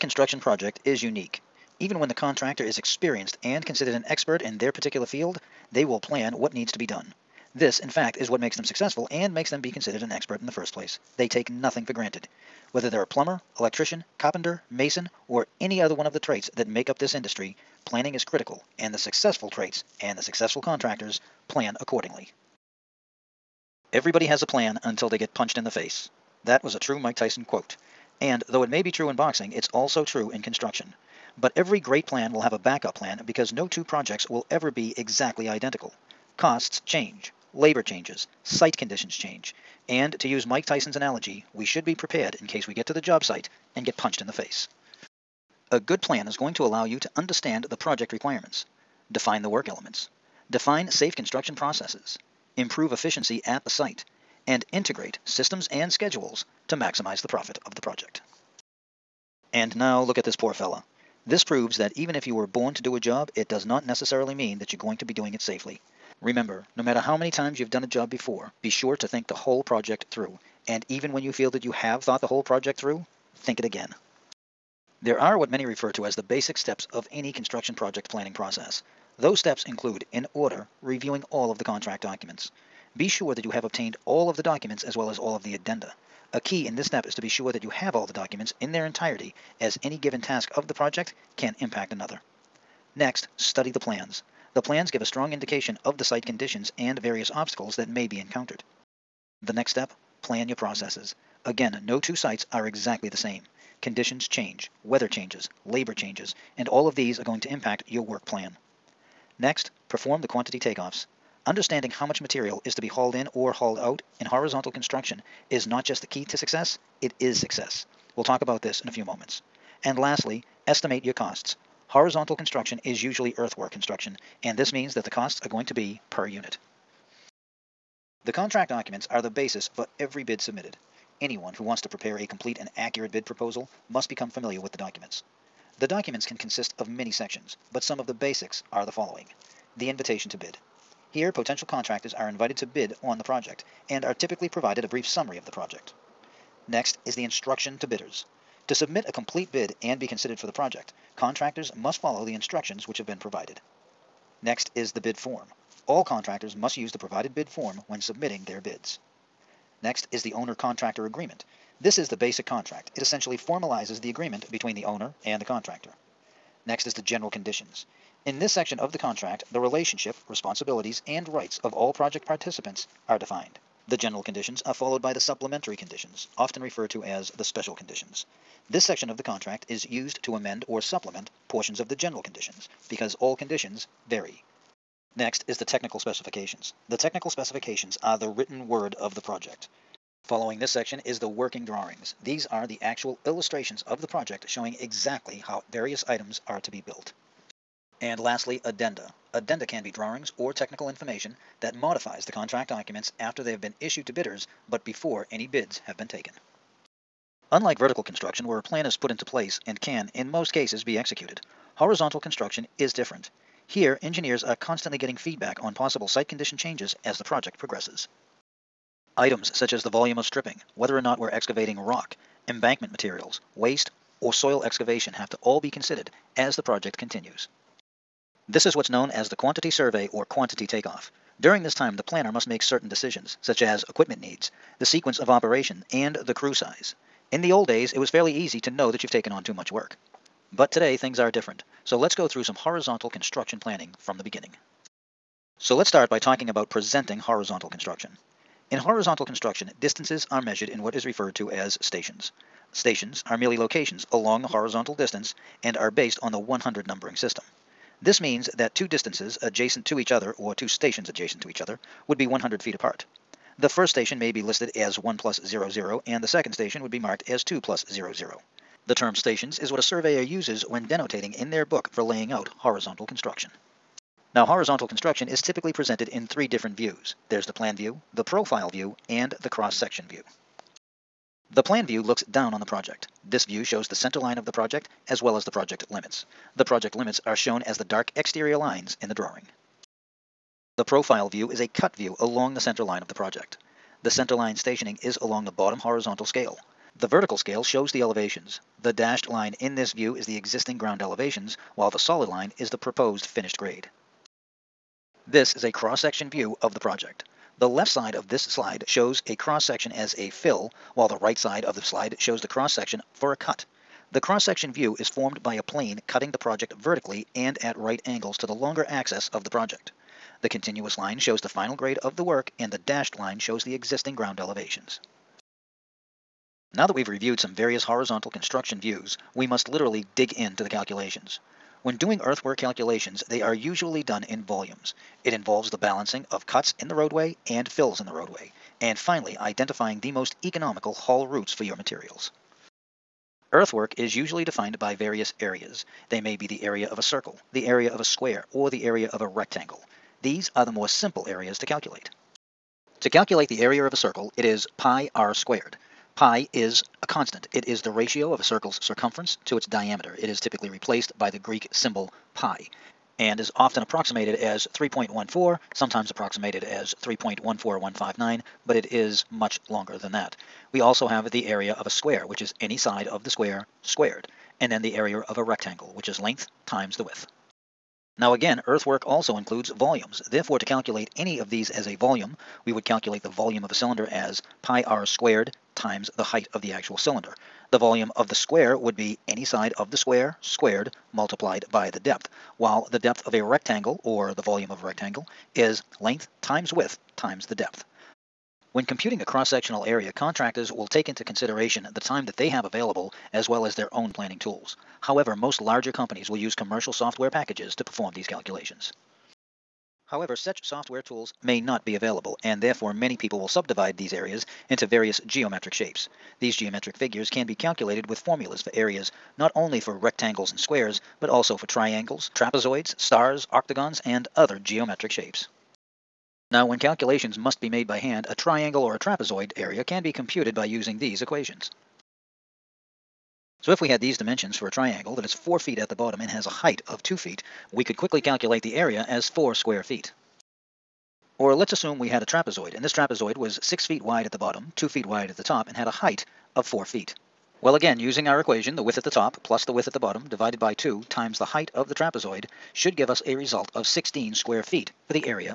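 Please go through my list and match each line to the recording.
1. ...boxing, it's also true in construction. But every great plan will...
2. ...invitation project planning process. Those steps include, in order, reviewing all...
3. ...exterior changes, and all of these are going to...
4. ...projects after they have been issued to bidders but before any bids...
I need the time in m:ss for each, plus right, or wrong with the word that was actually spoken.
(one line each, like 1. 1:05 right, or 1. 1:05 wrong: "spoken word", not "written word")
1. 0:29 right
2. 1:17 wrong: "construction", not "invitation"
3. 1:45 wrong: "labor", not "exterior"
4. 3:22 wrong: "documents", not "projects".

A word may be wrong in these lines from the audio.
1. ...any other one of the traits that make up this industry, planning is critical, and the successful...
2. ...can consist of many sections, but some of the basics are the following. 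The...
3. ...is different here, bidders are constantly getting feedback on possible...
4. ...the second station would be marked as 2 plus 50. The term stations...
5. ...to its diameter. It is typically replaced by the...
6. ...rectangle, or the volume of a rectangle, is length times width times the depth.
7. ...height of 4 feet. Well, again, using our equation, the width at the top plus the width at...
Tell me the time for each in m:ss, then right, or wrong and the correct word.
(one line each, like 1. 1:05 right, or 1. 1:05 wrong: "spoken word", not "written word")
1. 0:15 right
2. 2:16 right
3. 3:32 wrong: "engineers", not "bidders"
4. 4:26 wrong: "00", not "50"
5. 5:59 right
6. 6:33 right
7. 7:25 right.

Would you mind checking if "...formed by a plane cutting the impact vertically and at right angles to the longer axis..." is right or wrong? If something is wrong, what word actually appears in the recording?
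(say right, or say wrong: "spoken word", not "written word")
wrong: "project", not "impact".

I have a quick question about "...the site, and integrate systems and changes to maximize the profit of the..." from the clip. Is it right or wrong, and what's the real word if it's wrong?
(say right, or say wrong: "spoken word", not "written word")
wrong: "schedules", not "changes".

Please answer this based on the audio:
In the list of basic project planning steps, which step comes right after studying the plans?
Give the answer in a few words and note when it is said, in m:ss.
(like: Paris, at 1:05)
plan your processes, at 1:40.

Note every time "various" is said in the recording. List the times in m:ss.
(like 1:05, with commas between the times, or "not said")
1:36, 3:15, 5:27, 5:44, 6:54.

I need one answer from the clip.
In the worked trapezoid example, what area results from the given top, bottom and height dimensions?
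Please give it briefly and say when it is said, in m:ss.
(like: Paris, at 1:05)
16 square feet, at 7:33.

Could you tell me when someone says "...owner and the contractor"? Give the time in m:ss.
2:44.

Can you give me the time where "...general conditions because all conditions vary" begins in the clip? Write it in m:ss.
3:01.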